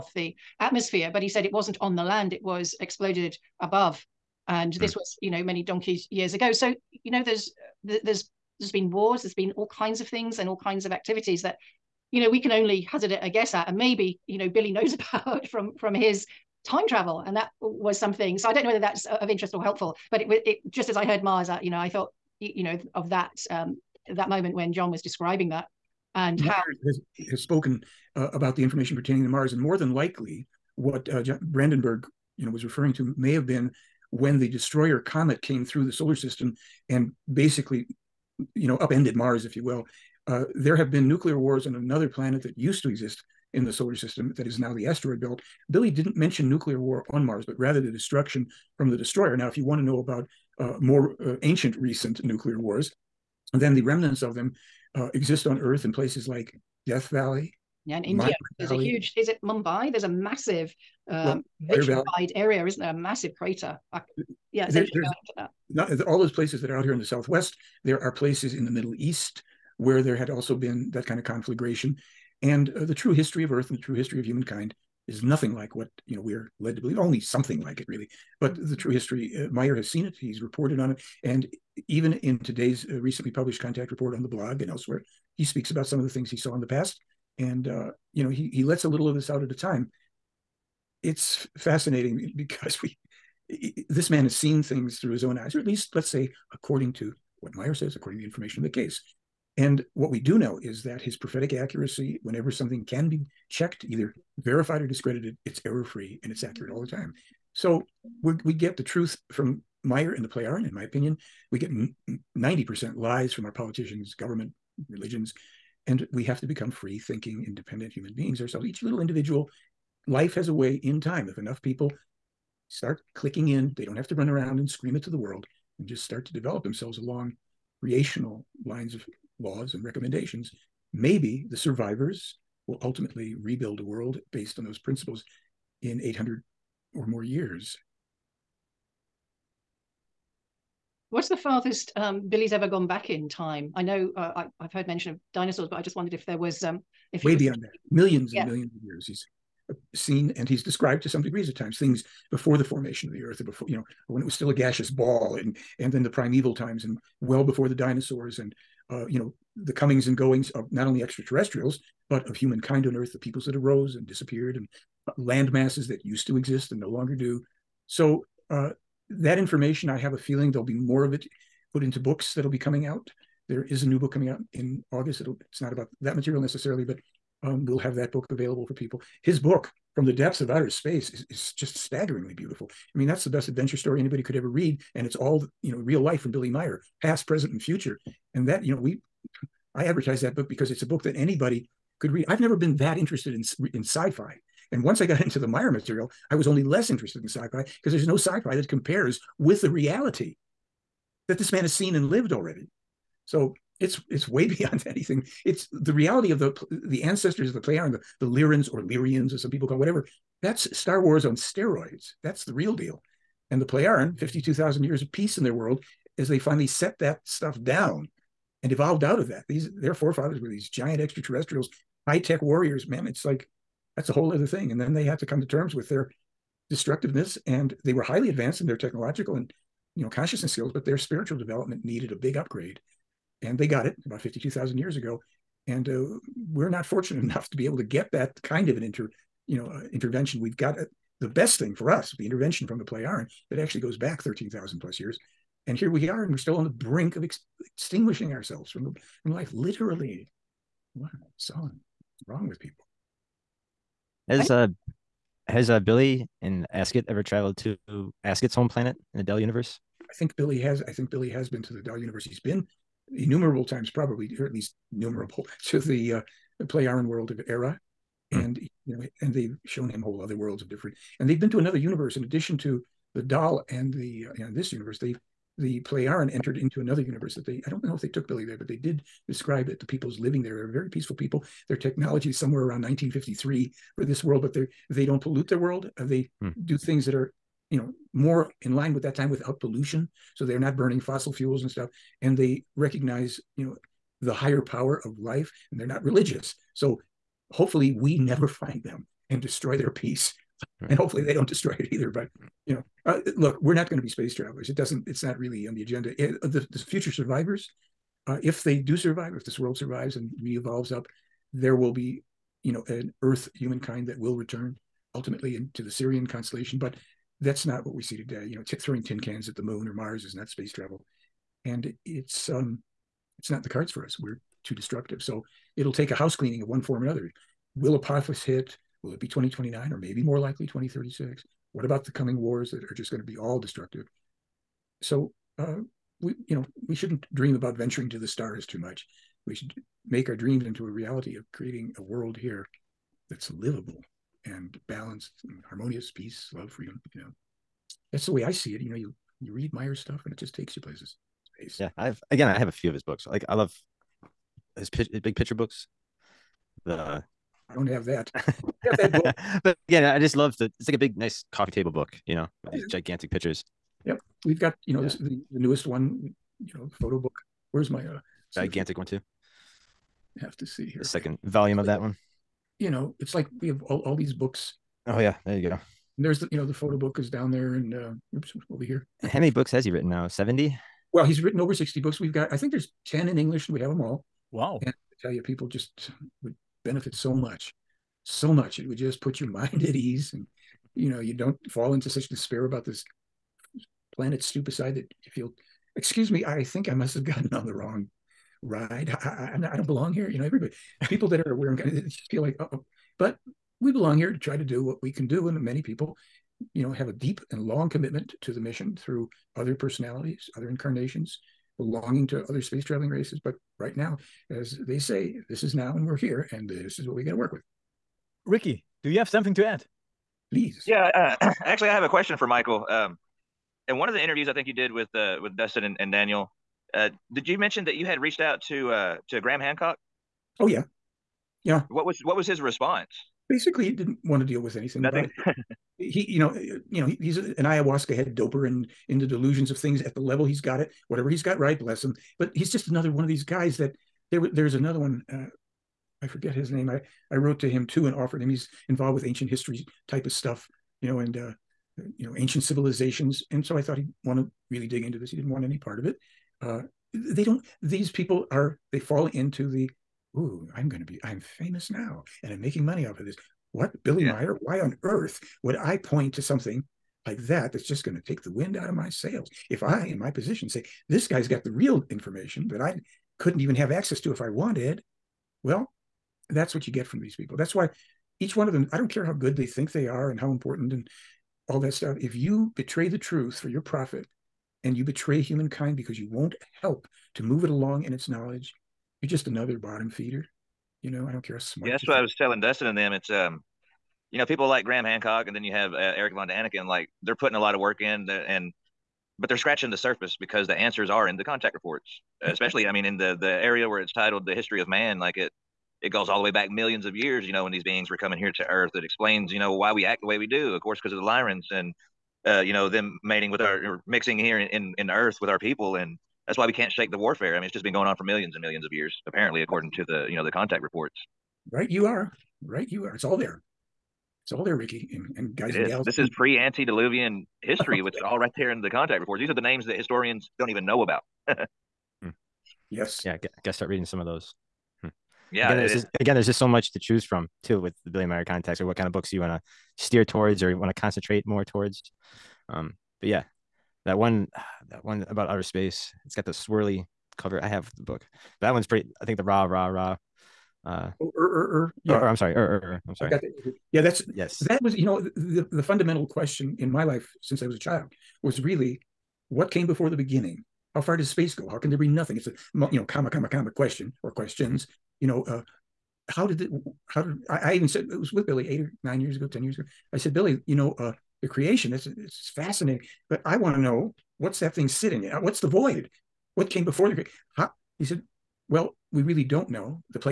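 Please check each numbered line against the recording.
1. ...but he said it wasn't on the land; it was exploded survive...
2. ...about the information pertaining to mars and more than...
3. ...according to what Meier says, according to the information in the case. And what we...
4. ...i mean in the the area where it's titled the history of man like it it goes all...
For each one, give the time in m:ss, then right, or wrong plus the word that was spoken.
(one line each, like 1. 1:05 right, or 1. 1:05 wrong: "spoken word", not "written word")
1. 0:01 wrong: "above", not "survive"
2. 0:28 right
3. 1:36 right
4. 8:22 right.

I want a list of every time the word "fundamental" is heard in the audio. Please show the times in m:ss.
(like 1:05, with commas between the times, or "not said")
9:15.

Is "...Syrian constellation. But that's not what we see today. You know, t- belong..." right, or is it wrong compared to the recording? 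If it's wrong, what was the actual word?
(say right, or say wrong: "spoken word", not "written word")
wrong: "throwing", not "belong".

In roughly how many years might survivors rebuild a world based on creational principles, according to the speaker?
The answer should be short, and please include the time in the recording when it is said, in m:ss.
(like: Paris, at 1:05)
800, at 2:15.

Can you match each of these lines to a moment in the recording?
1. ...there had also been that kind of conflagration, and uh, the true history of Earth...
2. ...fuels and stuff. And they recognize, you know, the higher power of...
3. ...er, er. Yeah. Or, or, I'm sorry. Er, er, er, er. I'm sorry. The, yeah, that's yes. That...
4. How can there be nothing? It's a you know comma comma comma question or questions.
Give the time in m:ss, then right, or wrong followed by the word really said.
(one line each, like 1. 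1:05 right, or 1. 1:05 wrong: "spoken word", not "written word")
1. 1:10 right
2. 4:51 right
3. 9:11 right
4. 9:21 right.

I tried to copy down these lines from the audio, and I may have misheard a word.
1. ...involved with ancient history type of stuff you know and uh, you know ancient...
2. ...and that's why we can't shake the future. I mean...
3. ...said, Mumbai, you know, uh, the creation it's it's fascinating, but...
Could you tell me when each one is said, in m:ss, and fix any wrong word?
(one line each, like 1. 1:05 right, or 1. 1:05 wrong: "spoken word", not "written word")
1. 7:28 right
2. 8:35 wrong: "warfare", not "future"
3. 9:30 wrong: "Billy", not "Mumbai".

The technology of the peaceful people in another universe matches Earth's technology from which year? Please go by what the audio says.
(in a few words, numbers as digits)
1953.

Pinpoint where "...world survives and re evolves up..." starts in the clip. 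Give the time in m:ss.
5:09.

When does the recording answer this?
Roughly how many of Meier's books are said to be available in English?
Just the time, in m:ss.
6:23.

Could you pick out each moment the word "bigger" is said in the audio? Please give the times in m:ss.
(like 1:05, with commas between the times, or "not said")
not said.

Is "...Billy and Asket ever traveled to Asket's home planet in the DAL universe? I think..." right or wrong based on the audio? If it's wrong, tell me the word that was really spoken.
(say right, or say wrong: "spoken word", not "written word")
right.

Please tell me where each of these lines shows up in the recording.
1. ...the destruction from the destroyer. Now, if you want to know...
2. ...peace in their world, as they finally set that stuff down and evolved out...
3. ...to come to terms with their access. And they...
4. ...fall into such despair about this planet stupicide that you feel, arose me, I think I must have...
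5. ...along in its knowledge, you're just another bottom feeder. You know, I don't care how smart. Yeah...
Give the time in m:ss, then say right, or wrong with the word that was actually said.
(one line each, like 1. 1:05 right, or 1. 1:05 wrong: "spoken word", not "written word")
1. 0:47 right
2. 3:35 right
3. 3:45 wrong: "destructiveness", not "access"
4. 6:31 wrong: "excuse", not "arose"
5. 8:07 right.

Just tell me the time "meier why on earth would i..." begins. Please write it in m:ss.
7:44.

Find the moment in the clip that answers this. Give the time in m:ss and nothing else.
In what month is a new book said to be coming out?
2:54.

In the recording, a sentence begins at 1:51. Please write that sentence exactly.
We get 90% lies from our politicians, government, religions.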